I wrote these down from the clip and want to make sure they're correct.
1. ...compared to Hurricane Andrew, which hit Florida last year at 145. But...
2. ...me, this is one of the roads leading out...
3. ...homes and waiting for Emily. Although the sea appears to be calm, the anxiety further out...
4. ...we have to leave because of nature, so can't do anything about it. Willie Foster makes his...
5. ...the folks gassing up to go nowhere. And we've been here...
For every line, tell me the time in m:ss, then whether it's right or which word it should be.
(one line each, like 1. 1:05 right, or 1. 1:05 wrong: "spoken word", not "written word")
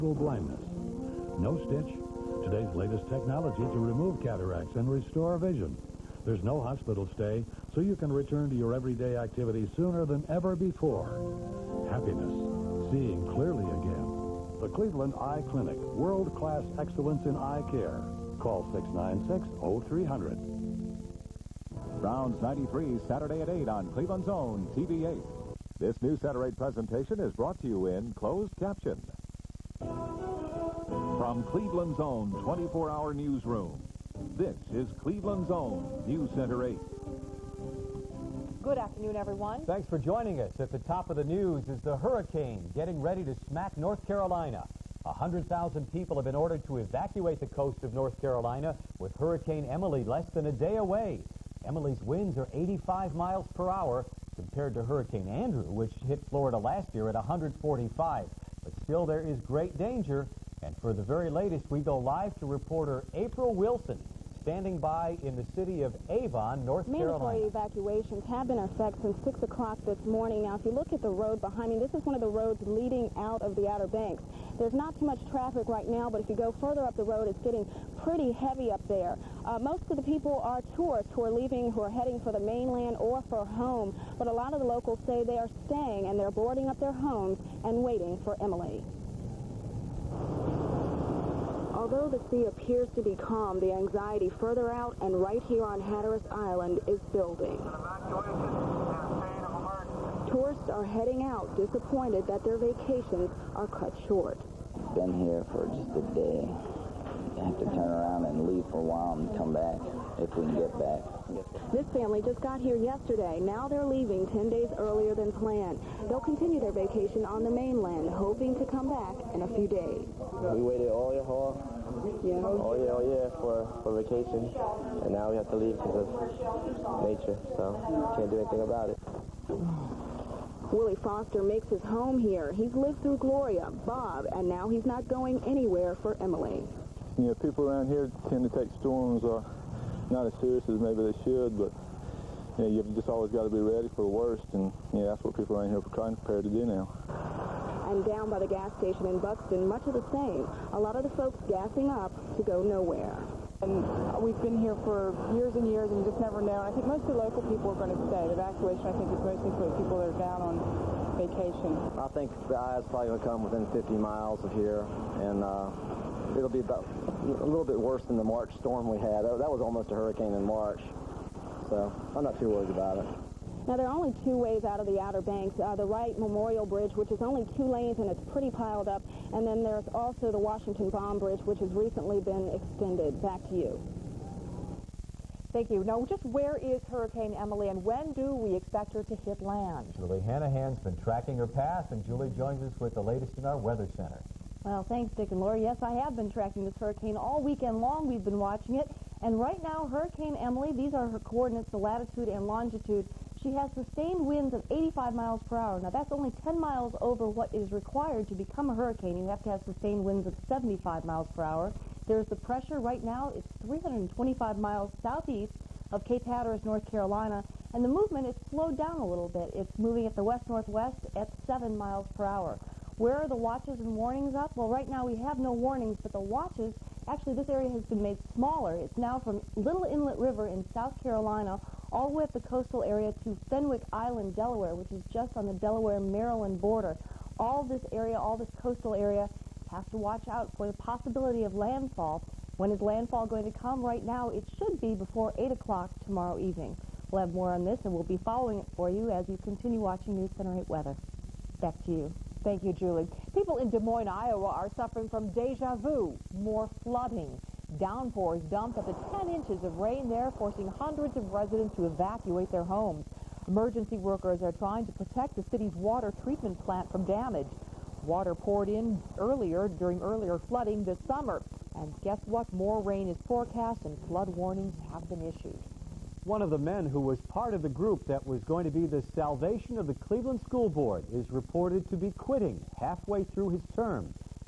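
1. 0:54 right
2. 1:11 right
3. 1:26 right
4. 2:05 right
5. 2:31 right.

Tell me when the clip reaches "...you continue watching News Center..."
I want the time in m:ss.
4:09.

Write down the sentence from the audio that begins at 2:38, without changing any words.
The evacuation, I think, is mostly for people that are down on vacation.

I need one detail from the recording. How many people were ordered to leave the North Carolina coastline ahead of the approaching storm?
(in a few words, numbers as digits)
100,000.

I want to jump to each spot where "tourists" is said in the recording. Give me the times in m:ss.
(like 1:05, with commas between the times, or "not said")
1:20, 1:40.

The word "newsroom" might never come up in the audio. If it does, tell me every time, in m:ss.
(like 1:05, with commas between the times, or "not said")
0:33.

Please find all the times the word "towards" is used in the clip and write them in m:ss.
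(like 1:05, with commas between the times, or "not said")
not said.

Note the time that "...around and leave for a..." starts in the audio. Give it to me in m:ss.
1:47.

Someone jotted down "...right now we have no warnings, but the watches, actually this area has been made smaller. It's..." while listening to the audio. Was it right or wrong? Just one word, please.
right.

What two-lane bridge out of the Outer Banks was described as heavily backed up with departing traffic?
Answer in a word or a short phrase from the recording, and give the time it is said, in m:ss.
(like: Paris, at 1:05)
Wright Memorial Bridge, at 2:55.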